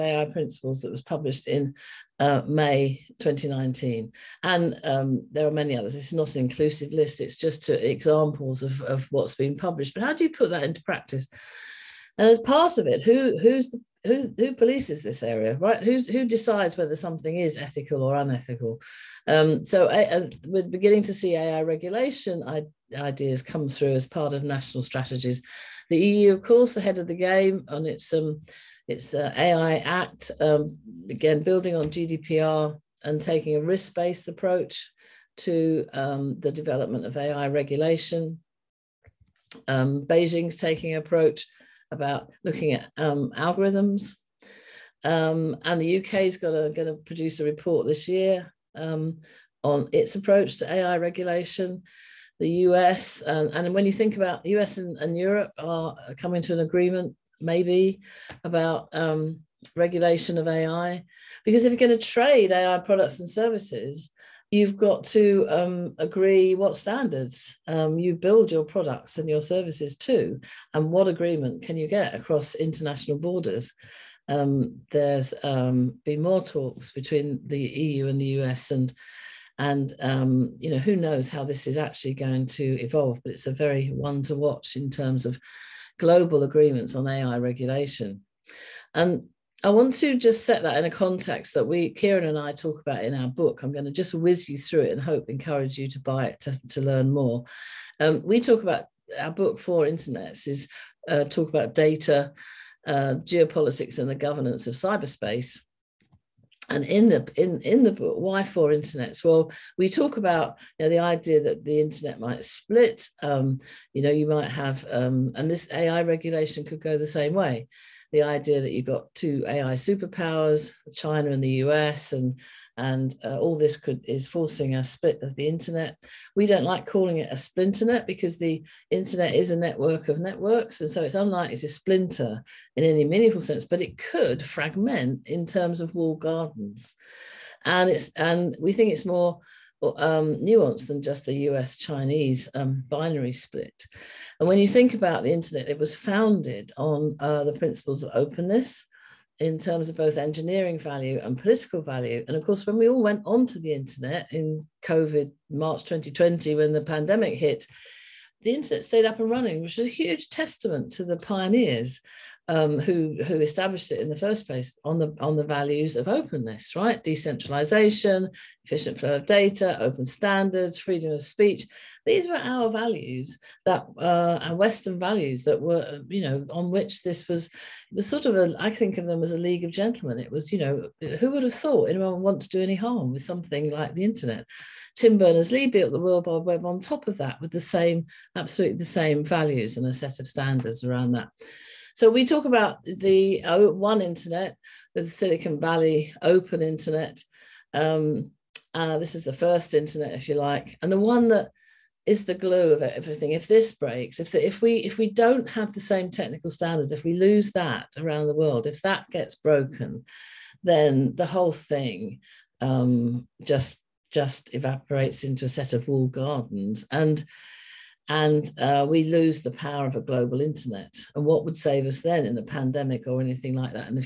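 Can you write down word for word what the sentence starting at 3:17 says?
Um, uh, this is the first internet, if you like, and the one that is the glue of everything.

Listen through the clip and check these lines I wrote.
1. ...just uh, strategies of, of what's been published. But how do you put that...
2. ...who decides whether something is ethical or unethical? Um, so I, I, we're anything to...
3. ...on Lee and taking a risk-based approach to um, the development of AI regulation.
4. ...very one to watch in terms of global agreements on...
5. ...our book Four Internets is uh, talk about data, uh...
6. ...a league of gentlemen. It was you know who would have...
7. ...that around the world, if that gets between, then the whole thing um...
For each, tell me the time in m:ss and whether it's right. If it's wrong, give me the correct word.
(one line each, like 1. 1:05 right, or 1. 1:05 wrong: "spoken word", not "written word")
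1. 0:07 wrong: "examples", not "strategies"
2. 0:16 wrong: "beginning", not "anything"
3. 0:31 wrong: "GDPR", not "Lee"
4. 1:23 right
5. 1:39 right
6. 2:59 right
7. 3:27 wrong: "broken", not "between".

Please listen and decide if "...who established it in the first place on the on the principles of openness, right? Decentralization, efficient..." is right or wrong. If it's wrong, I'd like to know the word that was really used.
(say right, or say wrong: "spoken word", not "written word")
wrong: "values", not "principles".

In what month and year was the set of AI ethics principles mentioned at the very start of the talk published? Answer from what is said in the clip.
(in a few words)
May 2019.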